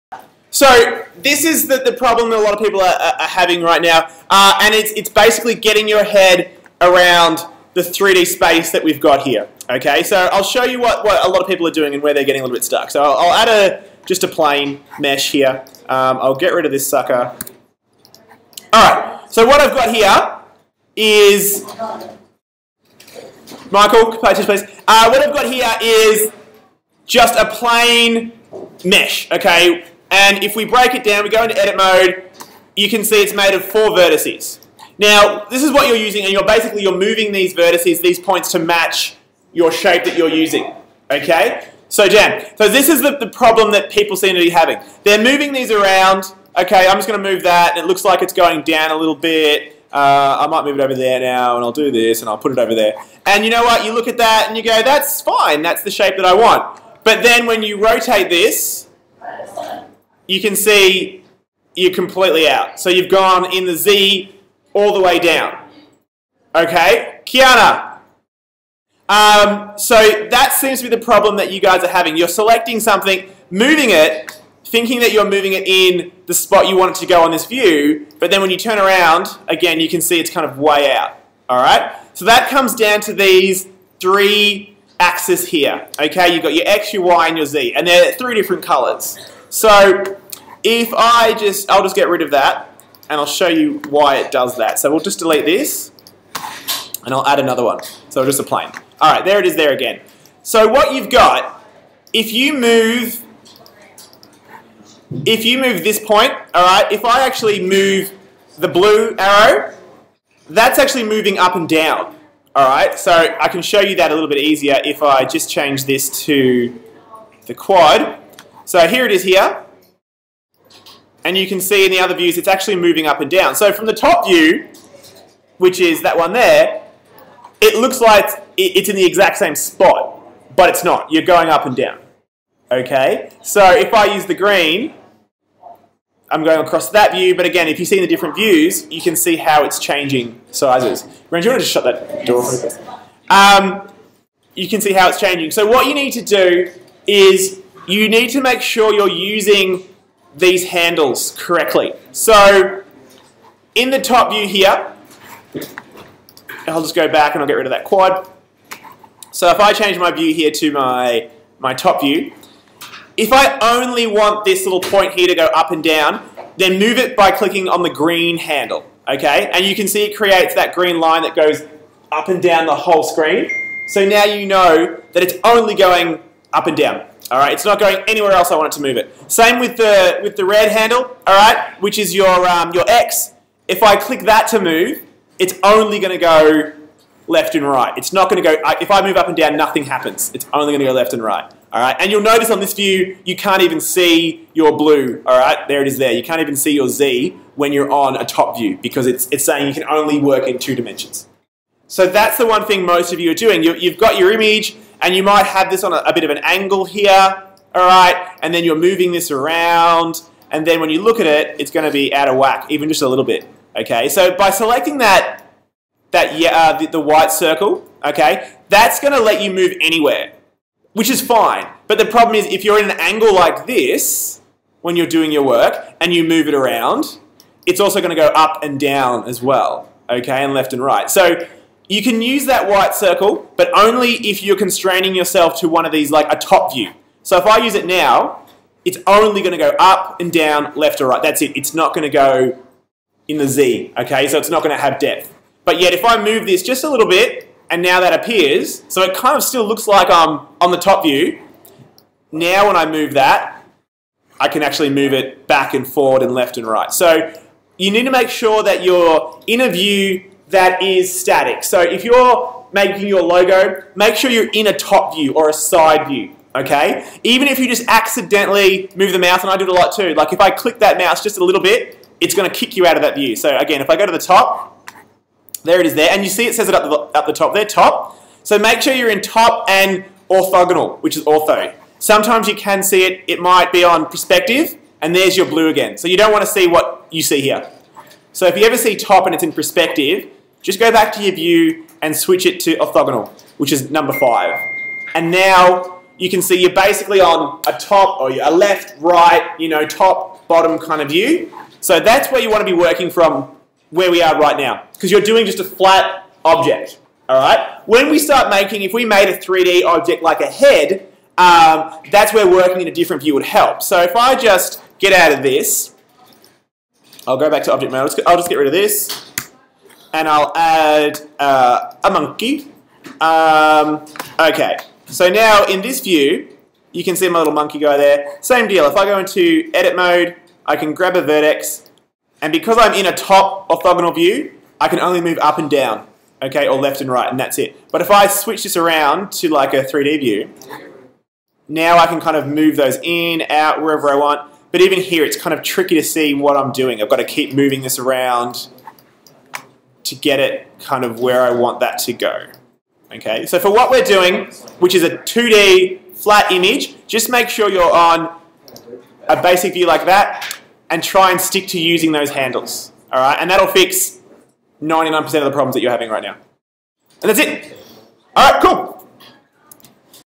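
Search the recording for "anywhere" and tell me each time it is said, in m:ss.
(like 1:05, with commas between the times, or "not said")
2:58, 3:39.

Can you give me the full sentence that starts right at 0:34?
Now, this is what you're using, and you're basically you're moving these vertices, these points, to match your shape that you're using.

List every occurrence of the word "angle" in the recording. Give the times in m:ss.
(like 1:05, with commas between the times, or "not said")
3:26, 3:42.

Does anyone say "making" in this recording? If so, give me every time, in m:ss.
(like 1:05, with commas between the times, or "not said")
4:22, 5:08.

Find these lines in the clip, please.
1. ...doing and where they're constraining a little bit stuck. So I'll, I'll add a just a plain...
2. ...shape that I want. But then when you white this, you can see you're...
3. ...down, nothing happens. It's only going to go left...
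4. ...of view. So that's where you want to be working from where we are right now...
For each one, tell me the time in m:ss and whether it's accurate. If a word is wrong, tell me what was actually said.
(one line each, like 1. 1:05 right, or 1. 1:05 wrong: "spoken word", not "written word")
1. 0:11 wrong: "getting", not "constraining"
2. 0:55 wrong: "rotate", not "white"
3. 3:09 right
4. 5:01 right.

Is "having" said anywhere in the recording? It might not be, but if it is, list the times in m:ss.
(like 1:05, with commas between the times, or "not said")
0:03, 0:44, 1:11, 6:05.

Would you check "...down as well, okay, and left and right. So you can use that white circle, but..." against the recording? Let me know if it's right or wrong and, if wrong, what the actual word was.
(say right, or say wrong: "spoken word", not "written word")
right.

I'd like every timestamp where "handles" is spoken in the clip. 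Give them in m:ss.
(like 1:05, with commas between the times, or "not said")
2:30, 2:48, 3:00, 6:02.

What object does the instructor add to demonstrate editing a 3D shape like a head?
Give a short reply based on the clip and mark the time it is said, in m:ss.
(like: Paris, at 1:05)
A monkey, at 5:22.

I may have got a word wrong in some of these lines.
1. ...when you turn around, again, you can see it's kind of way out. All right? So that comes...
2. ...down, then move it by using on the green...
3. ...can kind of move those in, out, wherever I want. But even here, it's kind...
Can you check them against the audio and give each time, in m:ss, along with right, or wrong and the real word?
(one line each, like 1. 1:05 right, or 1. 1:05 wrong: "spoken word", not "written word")
1. 1:18 right
2. 2:45 wrong: "clicking", not "using"
3. 5:42 right.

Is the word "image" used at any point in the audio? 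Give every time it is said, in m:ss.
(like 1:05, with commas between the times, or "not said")
3:24, 5:56.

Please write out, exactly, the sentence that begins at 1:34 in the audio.
So we'll just delete this, and I'll add another one.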